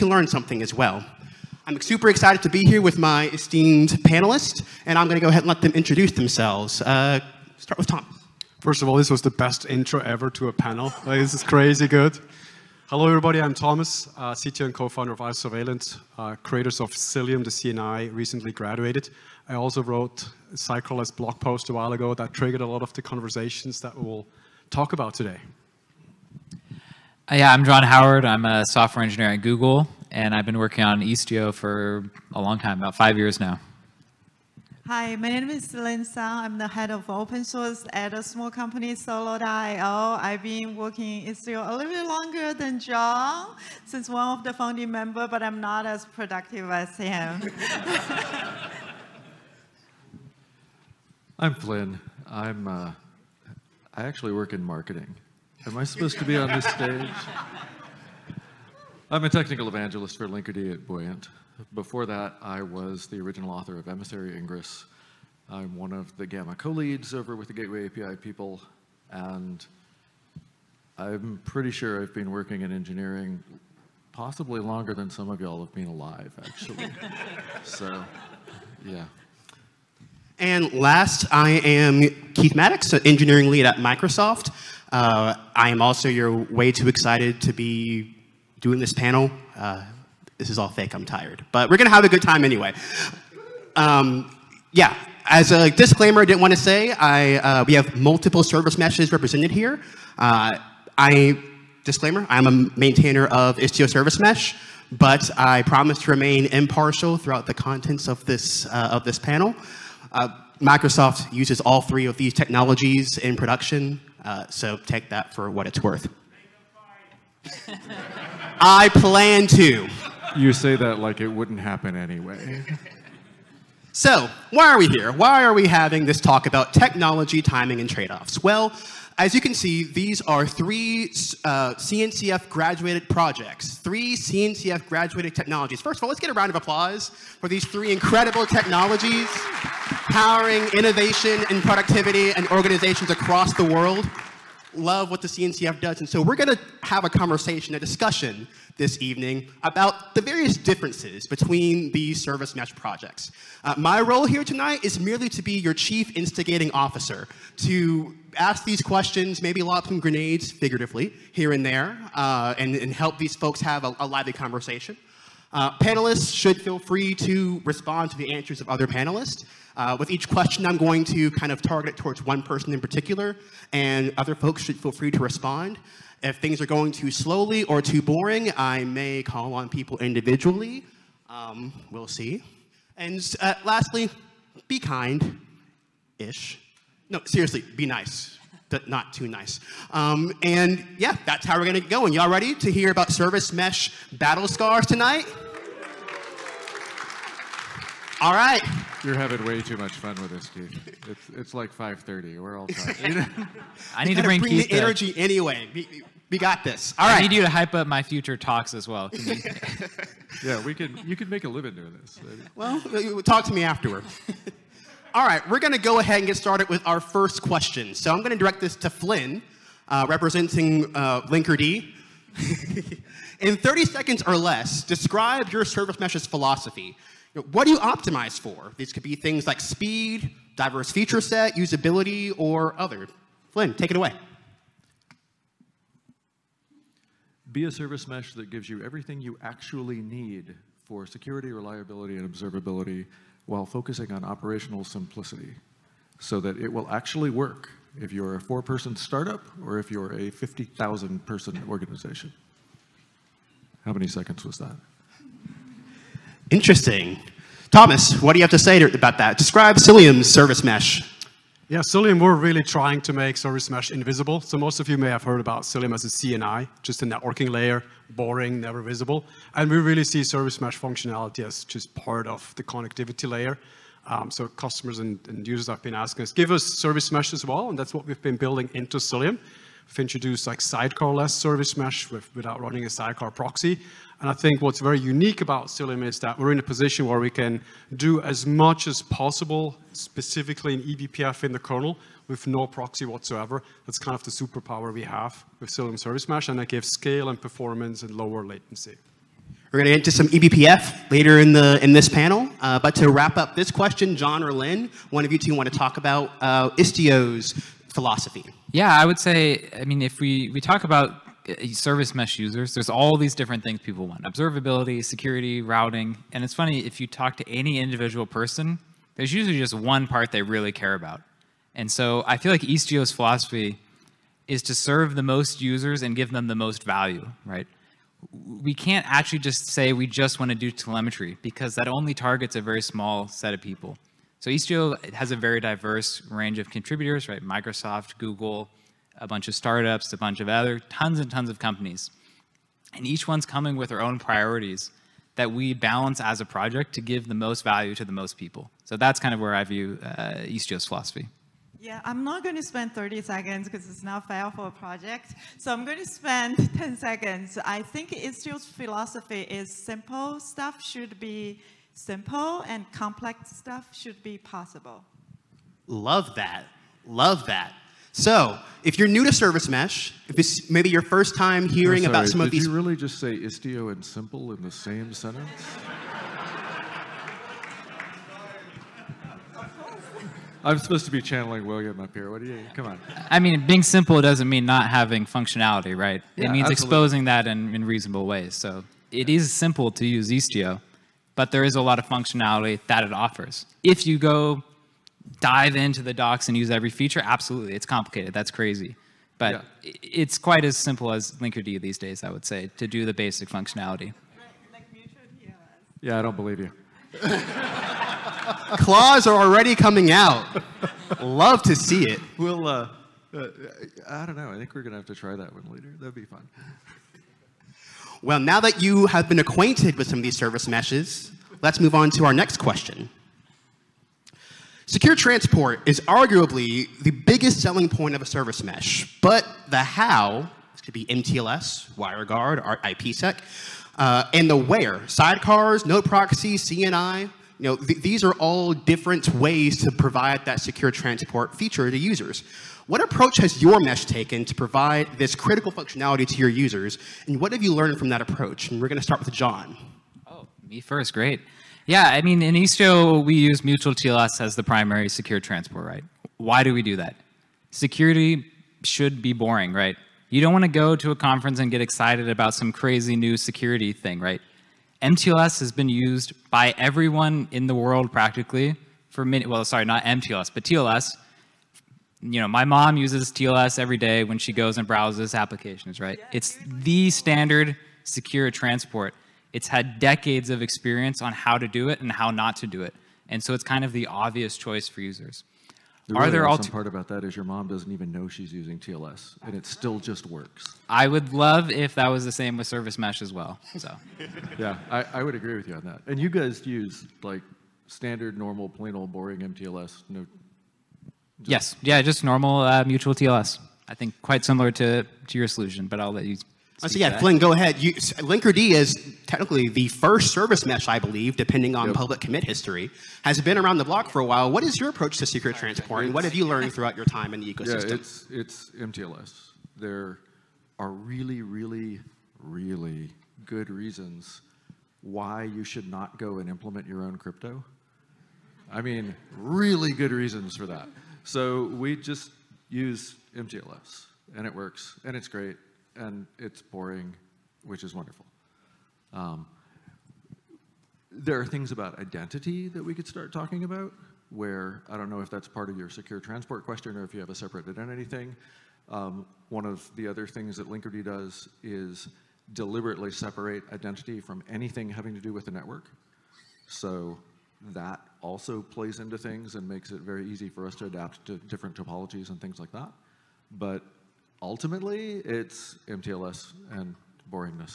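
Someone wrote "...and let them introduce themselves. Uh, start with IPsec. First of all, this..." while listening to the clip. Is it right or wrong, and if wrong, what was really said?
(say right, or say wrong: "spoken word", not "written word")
wrong: "Tom", not "IPsec".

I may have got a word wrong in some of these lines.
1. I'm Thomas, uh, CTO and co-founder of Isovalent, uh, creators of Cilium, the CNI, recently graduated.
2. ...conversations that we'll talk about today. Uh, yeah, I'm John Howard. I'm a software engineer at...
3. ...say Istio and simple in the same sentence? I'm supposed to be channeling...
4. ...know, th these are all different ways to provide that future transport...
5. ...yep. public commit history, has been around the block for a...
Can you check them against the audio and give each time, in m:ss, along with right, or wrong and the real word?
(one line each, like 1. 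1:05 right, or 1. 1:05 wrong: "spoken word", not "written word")
1. 0:13 right
2. 0:23 right
3. 6:13 right
4. 7:17 wrong: "secure", not "future"
5. 8:31 right.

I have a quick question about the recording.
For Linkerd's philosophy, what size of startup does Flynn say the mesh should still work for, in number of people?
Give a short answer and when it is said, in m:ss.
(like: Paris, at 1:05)
4, at 4:08.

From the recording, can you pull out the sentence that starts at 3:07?
No, seriously, be nice but not too nice.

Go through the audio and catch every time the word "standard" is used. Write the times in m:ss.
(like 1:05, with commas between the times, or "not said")
7:57, 8:17.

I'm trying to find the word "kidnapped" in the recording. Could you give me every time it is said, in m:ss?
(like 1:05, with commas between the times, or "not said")
not said.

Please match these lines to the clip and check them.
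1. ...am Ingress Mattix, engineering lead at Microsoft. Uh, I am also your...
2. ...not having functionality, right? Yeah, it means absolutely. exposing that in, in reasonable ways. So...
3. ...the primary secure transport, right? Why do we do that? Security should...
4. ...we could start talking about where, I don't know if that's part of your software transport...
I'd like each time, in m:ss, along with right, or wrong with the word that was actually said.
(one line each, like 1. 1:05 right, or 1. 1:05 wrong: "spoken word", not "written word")
1. 1:21 wrong: "Keith", not "Ingress"
2. 6:24 right
3. 7:34 right
4. 9:02 wrong: "secure", not "software".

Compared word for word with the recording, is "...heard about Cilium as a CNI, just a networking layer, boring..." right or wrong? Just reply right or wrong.
right.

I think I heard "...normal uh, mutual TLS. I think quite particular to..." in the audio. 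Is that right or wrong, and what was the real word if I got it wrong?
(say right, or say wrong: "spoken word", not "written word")
wrong: "similar", not "particular".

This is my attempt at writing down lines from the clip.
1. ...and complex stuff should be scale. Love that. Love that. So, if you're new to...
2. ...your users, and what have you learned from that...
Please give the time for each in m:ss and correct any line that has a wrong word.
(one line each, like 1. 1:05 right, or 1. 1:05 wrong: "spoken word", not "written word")
1. 6:02 wrong: "possible", not "scale"
2. 7:26 right.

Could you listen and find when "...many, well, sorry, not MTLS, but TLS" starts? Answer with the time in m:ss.
7:49.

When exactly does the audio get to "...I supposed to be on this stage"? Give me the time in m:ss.
0:55.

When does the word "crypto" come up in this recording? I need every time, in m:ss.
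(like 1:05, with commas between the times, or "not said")
8:47.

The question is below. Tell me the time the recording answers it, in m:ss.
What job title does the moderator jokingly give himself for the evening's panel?
2:35.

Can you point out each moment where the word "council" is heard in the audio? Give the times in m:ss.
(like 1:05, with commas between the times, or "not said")
not said.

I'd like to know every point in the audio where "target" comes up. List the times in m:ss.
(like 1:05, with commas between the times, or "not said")
2:51, 5:32.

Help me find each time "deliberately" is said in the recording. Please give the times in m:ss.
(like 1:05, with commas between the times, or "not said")
9:12.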